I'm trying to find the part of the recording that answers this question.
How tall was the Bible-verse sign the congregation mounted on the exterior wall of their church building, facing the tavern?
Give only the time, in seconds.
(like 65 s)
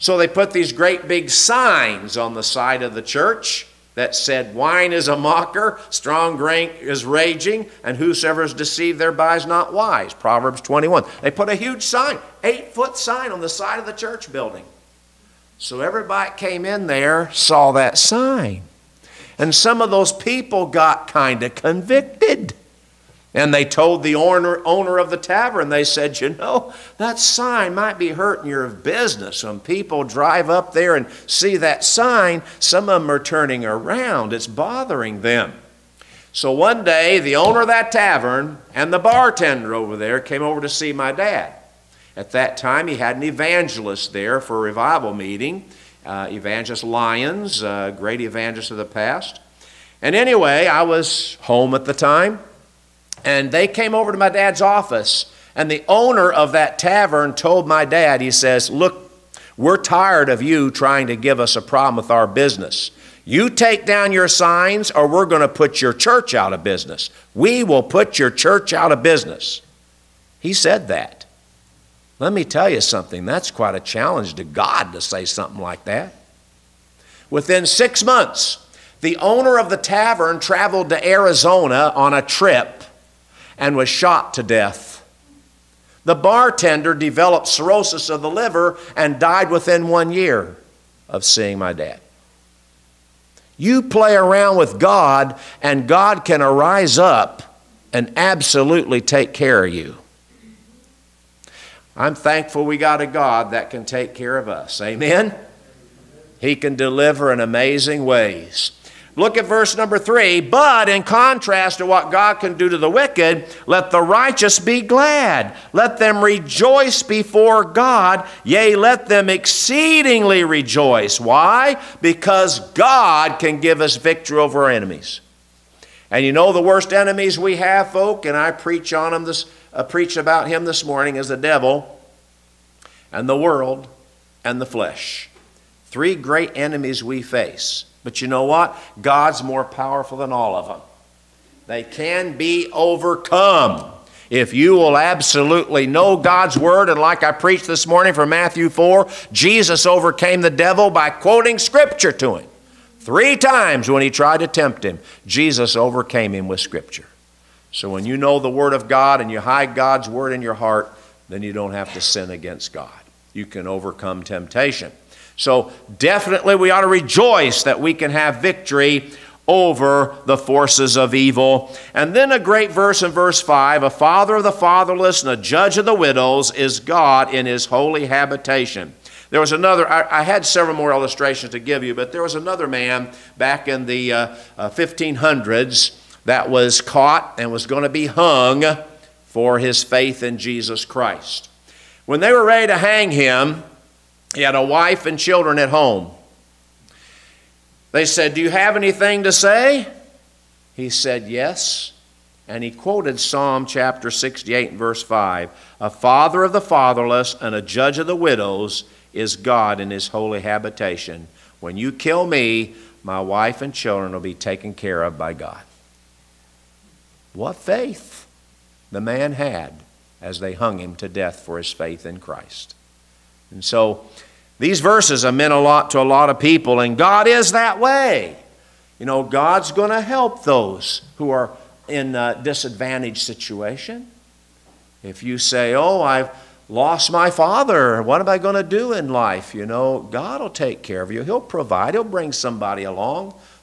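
12 s.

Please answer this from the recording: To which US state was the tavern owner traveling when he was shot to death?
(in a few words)
Arizona.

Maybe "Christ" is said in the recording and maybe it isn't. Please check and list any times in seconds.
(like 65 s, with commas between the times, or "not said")
190 s, 222 s.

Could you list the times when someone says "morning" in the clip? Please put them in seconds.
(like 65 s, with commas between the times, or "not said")
130 s, 147 s.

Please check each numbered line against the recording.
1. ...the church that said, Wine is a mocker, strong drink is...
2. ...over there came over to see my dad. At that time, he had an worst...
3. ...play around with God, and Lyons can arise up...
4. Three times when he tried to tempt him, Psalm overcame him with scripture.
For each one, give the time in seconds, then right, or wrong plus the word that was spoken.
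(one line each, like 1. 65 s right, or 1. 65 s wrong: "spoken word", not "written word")
1. 2 s right
2. 39 s wrong: "evangelist", not "worst"
3. 93 s wrong: "God", not "Lyons"
4. 152 s wrong: "Jesus", not "Psalm".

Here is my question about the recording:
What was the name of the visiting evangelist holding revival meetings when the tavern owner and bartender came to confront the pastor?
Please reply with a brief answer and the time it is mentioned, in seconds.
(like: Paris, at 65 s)
Lyons, at 46 s.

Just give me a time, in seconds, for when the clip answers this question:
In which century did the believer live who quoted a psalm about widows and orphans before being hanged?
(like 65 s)
184 s.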